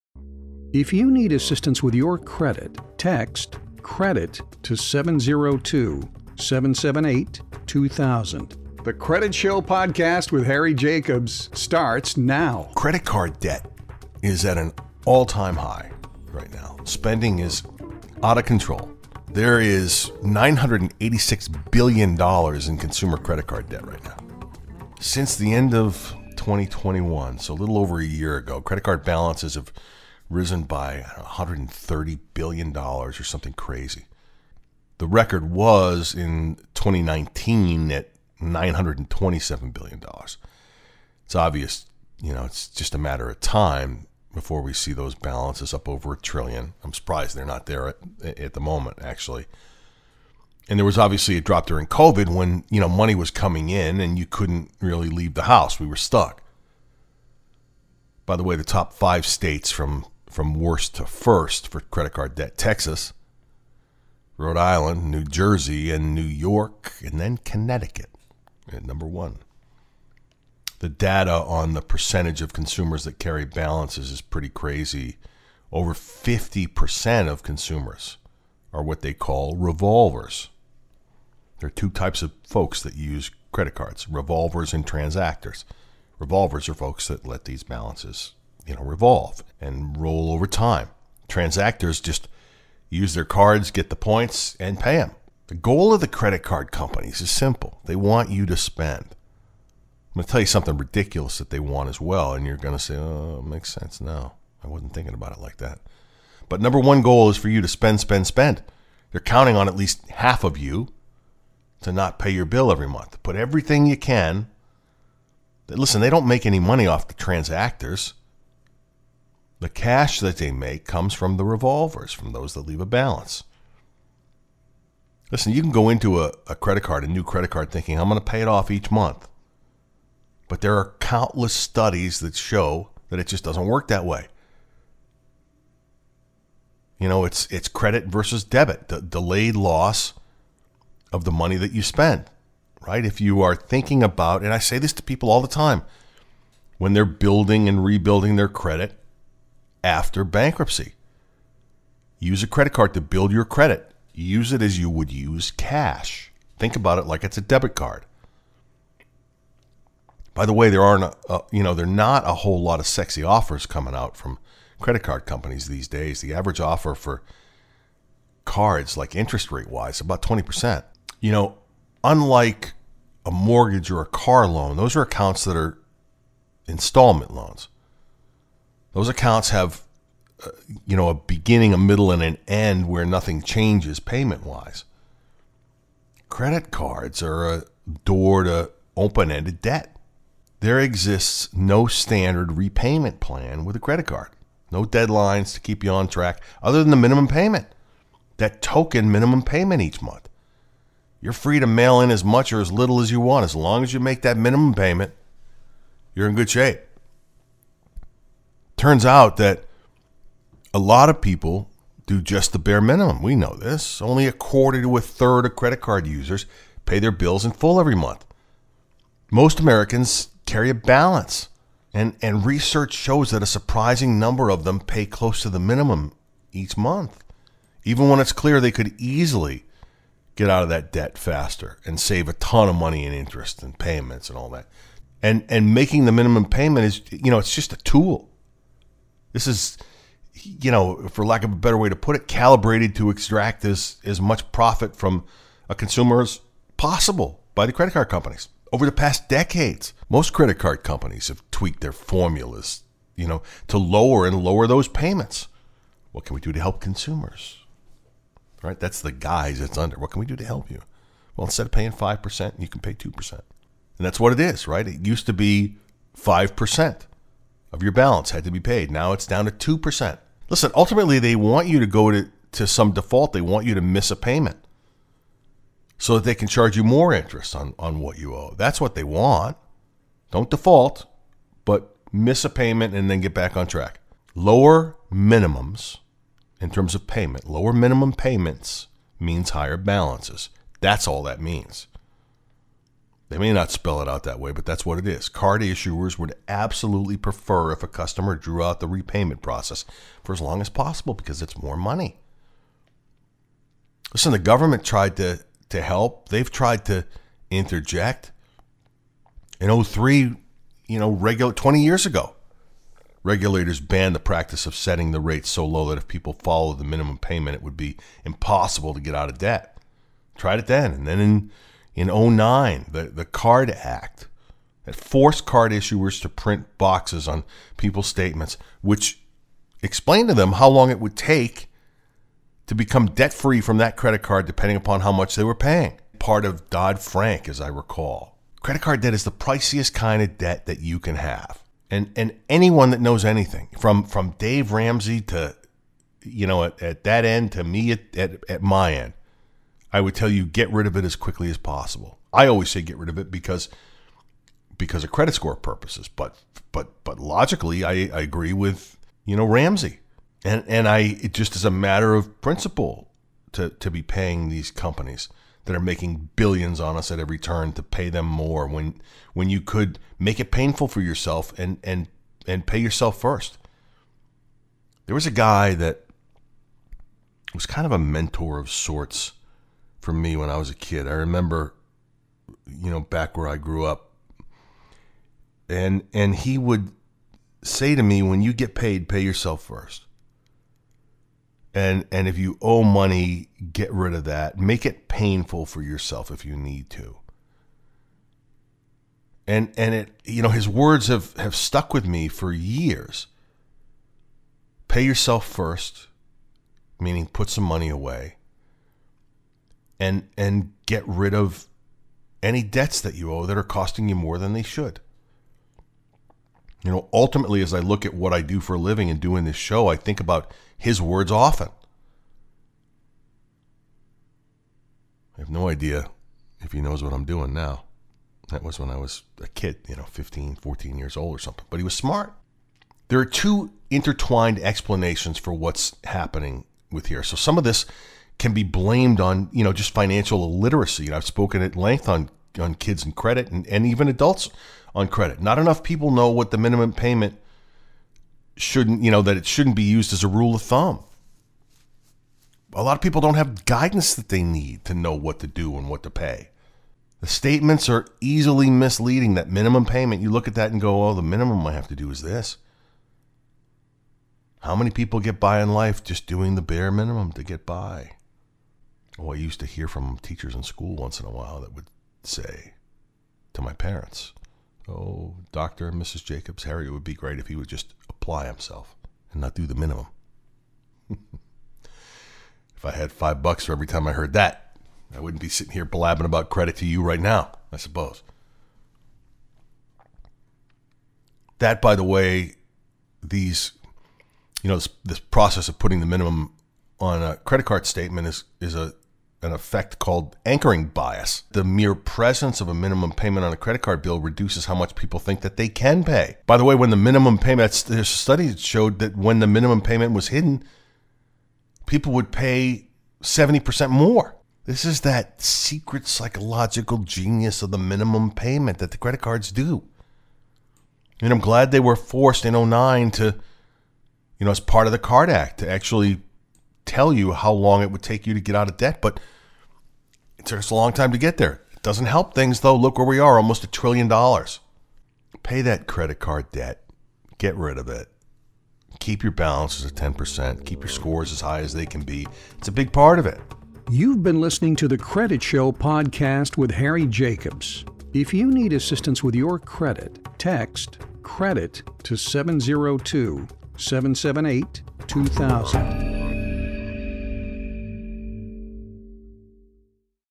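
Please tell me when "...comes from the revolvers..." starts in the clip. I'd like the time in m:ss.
2:00.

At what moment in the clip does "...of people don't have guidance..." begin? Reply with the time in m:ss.
7:32.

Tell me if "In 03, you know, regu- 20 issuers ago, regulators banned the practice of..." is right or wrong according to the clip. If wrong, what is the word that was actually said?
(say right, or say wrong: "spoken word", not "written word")
wrong: "years", not "issuers".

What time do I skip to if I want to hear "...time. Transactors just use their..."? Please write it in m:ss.
1:30.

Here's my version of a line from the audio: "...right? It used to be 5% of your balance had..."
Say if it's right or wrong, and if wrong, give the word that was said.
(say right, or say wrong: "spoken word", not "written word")
right.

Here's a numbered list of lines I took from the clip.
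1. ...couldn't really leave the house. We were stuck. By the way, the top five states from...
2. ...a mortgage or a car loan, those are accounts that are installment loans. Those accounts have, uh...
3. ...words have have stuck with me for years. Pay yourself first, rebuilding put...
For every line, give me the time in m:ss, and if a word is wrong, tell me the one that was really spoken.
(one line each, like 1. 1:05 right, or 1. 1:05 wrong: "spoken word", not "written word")
1. 0:54 right
2. 2:53 right
3. 6:40 wrong: "meaning", not "rebuilding".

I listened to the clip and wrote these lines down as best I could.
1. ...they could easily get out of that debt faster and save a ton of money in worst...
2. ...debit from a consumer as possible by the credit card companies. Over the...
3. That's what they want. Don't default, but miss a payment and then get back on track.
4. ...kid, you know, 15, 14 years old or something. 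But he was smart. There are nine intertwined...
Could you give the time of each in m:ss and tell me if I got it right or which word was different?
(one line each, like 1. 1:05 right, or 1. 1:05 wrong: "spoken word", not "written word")
1. 3:48 wrong: "interest", not "worst"
2. 4:04 wrong: "profit", not "debit"
3. 4:38 right
4. 7:09 wrong: "two", not "nine".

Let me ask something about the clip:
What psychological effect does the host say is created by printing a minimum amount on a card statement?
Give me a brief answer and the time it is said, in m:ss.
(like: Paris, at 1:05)
Anchoring bias, at 8:20.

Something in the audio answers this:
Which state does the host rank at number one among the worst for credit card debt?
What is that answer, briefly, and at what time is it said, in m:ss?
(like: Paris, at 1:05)
Connecticut, at 1:07.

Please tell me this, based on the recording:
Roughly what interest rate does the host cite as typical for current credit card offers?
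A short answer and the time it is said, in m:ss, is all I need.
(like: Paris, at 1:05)
20%, at 2:49.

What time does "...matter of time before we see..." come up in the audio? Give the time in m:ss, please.
0:42.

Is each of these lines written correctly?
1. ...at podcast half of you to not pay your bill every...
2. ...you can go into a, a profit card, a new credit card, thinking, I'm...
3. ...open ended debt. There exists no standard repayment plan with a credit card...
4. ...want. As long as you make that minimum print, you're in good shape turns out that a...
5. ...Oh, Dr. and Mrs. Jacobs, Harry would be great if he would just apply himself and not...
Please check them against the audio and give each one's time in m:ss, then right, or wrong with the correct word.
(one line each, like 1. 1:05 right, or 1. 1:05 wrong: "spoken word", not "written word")
1. 1:49 wrong: "least", not "podcast"
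2. 2:05 wrong: "credit", not "profit"
3. 3:08 right
4. 3:23 wrong: "payment", not "print"
5. 7:54 right.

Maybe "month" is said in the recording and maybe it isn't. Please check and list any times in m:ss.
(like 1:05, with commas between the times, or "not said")
1:52, 2:08, 3:20, 3:37, 3:46.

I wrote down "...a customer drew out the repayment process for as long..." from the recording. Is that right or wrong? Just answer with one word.
right.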